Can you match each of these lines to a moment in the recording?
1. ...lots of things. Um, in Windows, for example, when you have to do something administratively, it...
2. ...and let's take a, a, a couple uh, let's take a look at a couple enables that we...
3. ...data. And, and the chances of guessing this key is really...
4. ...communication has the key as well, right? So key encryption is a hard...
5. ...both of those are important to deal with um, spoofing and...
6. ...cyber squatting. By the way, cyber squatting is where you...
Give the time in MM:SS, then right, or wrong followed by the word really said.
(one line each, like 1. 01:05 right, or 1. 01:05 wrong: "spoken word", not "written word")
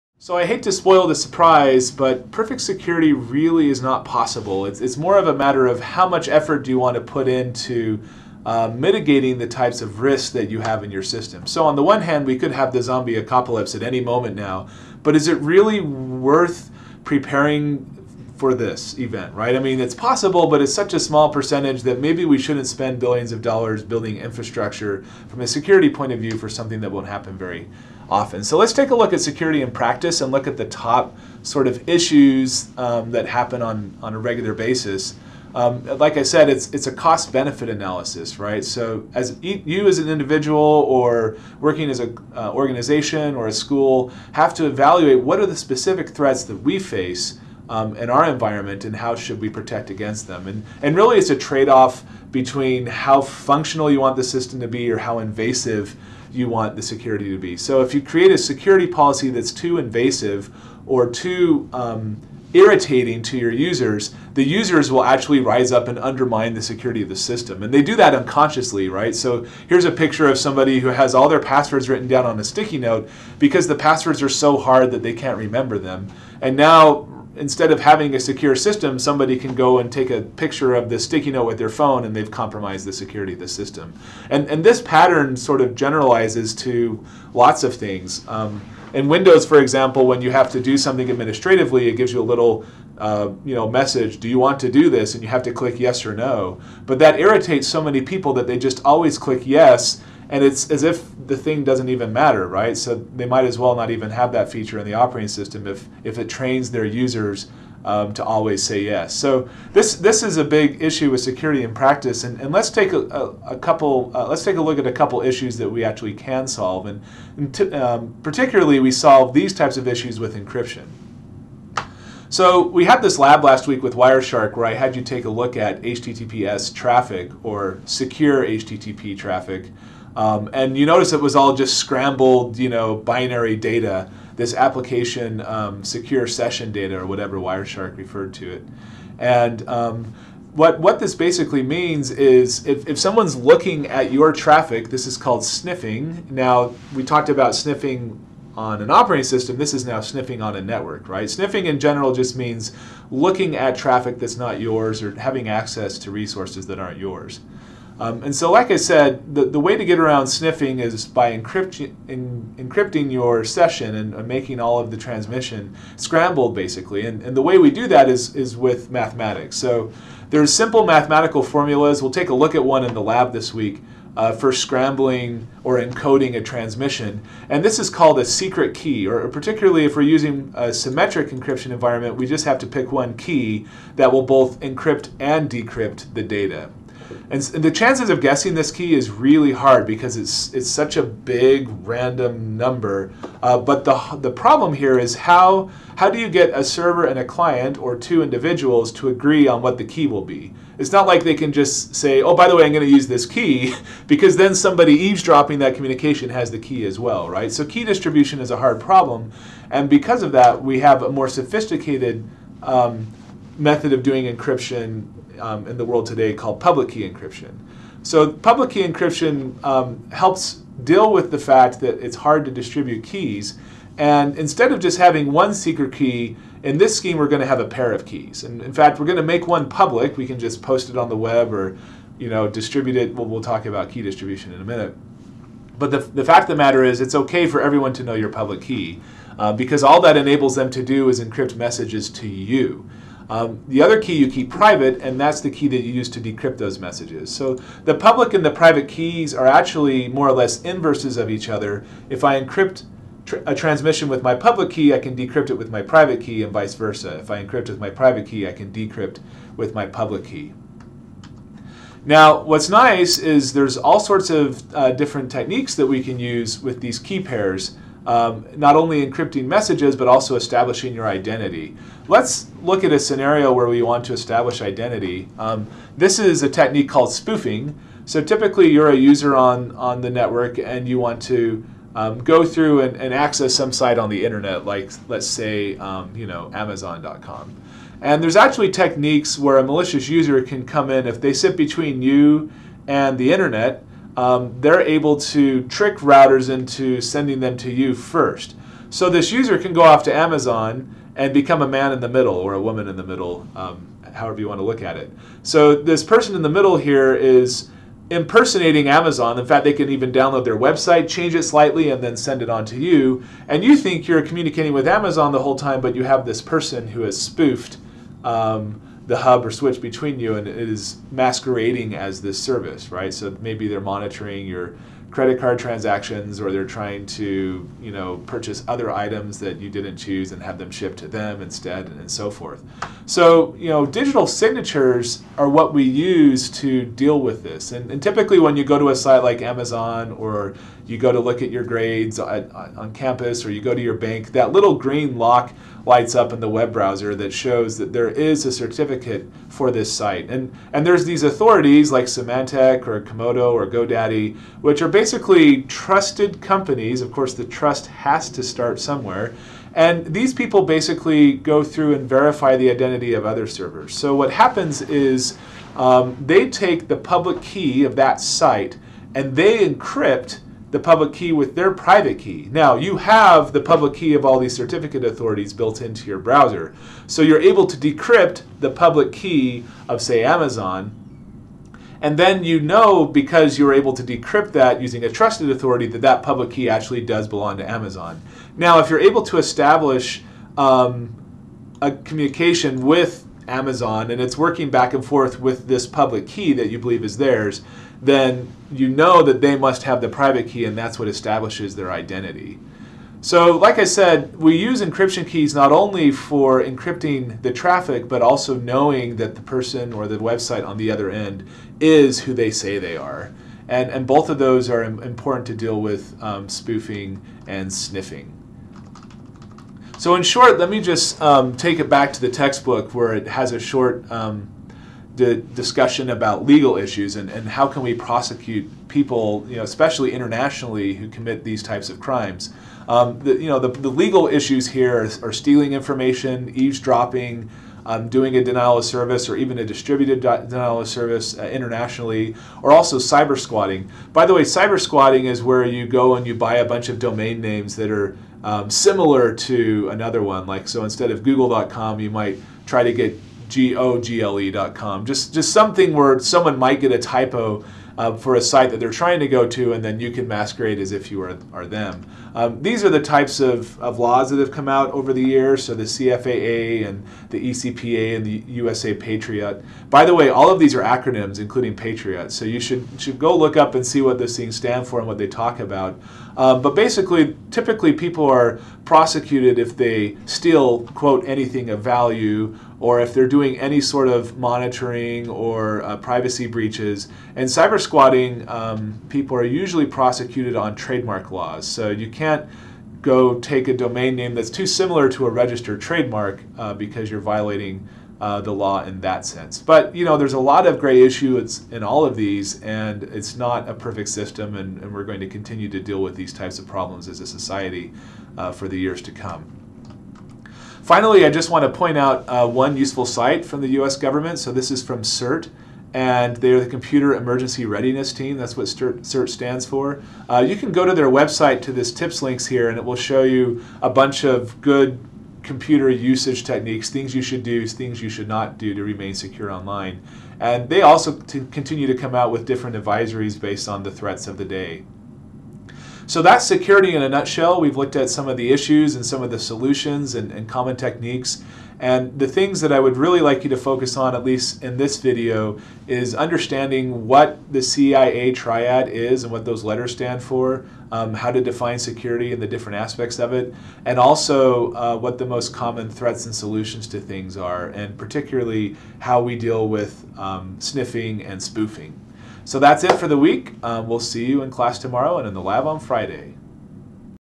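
1. 01:27 right
2. 01:52 wrong: "issues", not "enables"
3. 03:06 right
4. 03:25 wrong: "distribution", not "encryption"
5. 06:54 right
6. 07:22 right.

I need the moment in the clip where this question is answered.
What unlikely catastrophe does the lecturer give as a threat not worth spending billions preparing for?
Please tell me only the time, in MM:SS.
00:12.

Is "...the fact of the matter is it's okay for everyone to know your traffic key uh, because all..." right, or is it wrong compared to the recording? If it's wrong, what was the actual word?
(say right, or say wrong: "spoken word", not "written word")
wrong: "public", not "traffic".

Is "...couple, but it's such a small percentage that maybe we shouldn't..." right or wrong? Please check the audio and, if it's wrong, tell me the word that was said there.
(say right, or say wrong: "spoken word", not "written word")
wrong: "possible", not "couple".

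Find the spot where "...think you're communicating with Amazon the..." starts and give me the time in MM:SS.
05:13.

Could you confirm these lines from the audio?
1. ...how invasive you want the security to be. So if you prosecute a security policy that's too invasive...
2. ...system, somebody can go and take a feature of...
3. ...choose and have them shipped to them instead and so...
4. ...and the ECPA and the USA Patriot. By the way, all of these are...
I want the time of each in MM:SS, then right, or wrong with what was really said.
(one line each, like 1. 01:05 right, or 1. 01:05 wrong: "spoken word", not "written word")
1. 00:54 wrong: "create", not "prosecute"
2. 01:18 wrong: "picture", not "feature"
3. 05:29 right
4. 07:46 right.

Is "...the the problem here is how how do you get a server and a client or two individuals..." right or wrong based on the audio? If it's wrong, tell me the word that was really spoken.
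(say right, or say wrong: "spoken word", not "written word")
right.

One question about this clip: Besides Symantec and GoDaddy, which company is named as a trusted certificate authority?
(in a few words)
Comodo.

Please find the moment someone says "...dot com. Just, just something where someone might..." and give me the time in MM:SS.
07:34.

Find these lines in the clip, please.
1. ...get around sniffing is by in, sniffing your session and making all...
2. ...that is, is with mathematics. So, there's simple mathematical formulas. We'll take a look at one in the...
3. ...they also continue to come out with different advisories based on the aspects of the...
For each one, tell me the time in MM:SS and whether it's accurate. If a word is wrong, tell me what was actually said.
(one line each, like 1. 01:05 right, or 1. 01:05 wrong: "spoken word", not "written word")
1. 02:39 wrong: "encrypting", not "sniffing"
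2. 02:47 right
3. 08:50 wrong: "threats", not "aspects".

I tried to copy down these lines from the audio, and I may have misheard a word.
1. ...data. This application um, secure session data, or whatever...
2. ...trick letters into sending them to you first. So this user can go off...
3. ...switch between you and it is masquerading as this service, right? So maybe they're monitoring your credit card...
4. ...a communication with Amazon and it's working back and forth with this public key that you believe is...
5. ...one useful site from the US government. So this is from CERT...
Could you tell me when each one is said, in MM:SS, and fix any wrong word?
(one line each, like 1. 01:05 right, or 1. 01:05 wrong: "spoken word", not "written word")
1. 02:13 right
2. 04:55 wrong: "routers", not "letters"
3. 05:19 right
4. 06:31 right
5. 08:32 right.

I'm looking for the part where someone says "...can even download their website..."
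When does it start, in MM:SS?
05:09.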